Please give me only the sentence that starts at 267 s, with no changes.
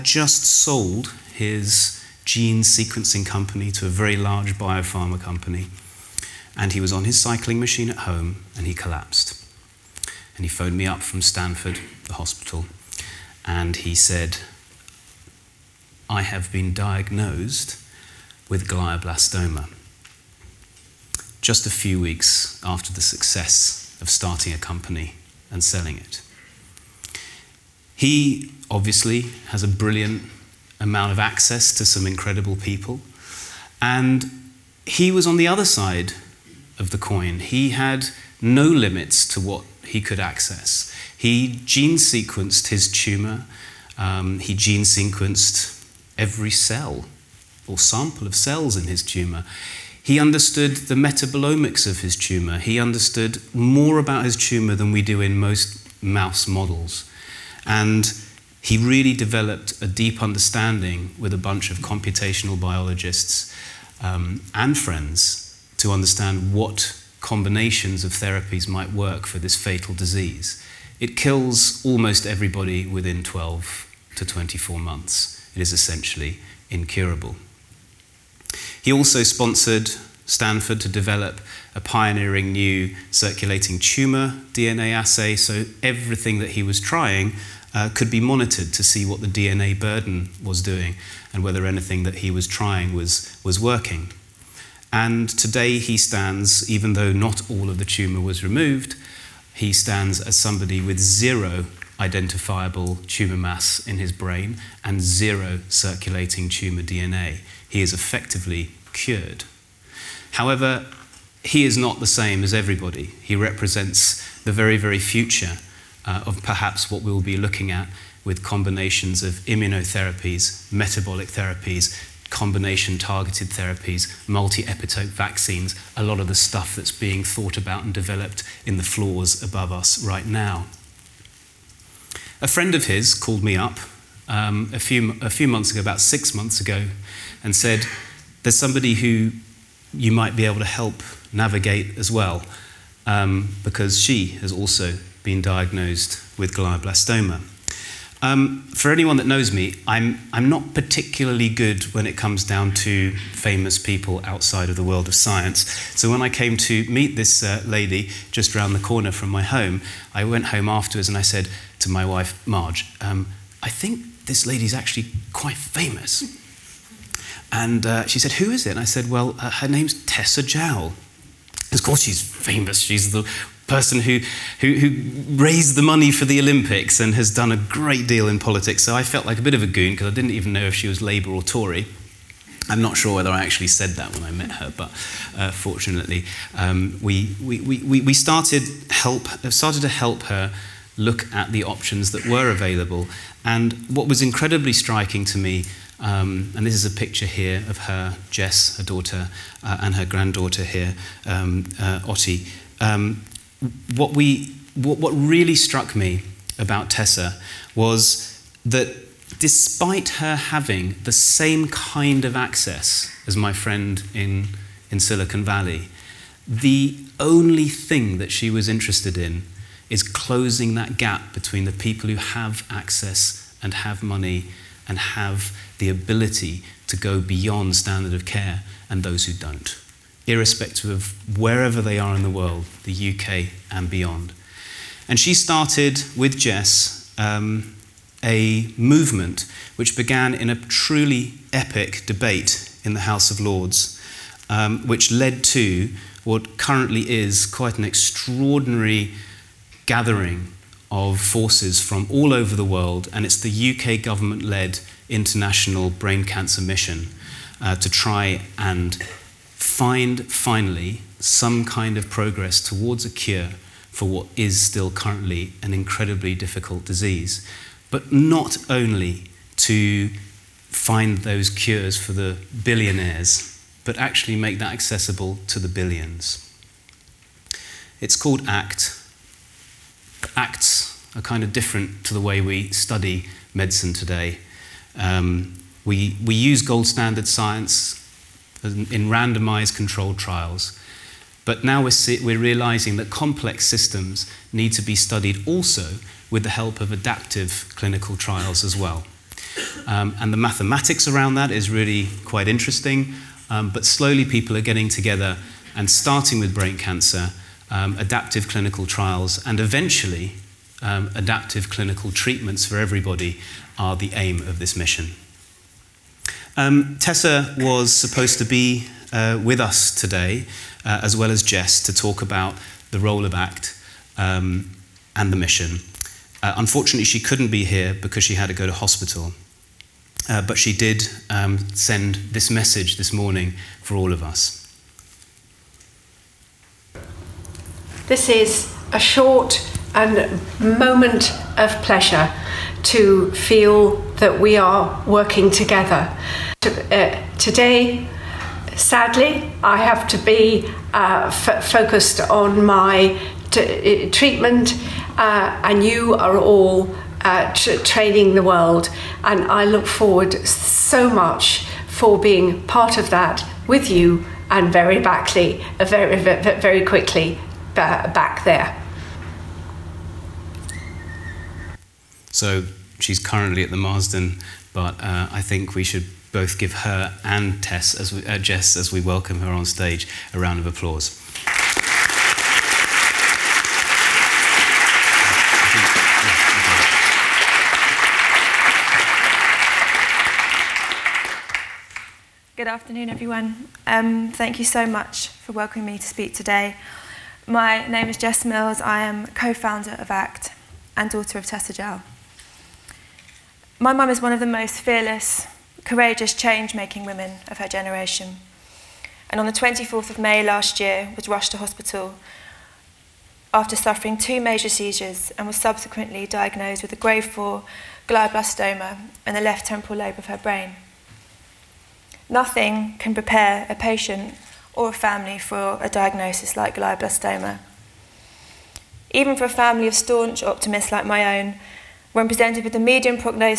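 But not only to find those cures for the billionaires, but actually make that accessible to the billions.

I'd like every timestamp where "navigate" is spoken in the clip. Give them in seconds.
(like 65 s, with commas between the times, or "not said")
141 s.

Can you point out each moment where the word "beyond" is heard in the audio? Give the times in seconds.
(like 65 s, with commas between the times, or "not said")
227 s, 233 s.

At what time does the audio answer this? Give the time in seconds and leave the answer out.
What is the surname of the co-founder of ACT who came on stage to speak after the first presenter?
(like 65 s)
398 s.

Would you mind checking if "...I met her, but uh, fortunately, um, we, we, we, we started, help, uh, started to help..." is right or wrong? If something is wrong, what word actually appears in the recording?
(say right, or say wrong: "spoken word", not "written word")
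right.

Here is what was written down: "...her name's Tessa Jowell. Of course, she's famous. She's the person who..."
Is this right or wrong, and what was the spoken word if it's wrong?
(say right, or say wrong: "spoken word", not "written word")
right.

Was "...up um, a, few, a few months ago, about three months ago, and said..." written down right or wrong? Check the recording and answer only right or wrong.
wrong.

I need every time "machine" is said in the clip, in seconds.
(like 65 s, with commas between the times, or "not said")
7 s.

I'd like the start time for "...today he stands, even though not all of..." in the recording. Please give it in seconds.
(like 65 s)
95 s.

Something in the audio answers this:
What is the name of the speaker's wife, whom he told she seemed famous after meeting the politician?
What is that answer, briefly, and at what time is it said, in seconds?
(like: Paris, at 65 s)
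Marge, at 162 s.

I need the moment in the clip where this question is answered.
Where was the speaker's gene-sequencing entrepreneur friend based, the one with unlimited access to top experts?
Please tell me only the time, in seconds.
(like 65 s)
214 s.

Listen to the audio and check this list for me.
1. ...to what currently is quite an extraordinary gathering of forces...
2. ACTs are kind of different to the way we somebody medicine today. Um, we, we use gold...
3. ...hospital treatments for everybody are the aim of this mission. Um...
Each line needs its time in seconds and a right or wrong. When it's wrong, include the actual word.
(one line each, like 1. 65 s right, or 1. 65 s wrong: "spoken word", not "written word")
1. 245 s right
2. 280 s wrong: "study", not "somebody"
3. 311 s wrong: "clinical", not "hospital".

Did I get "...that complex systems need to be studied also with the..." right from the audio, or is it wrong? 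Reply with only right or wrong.
right.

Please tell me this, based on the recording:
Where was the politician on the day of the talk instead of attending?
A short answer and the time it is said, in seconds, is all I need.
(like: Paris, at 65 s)
the Marsden, at 373 s.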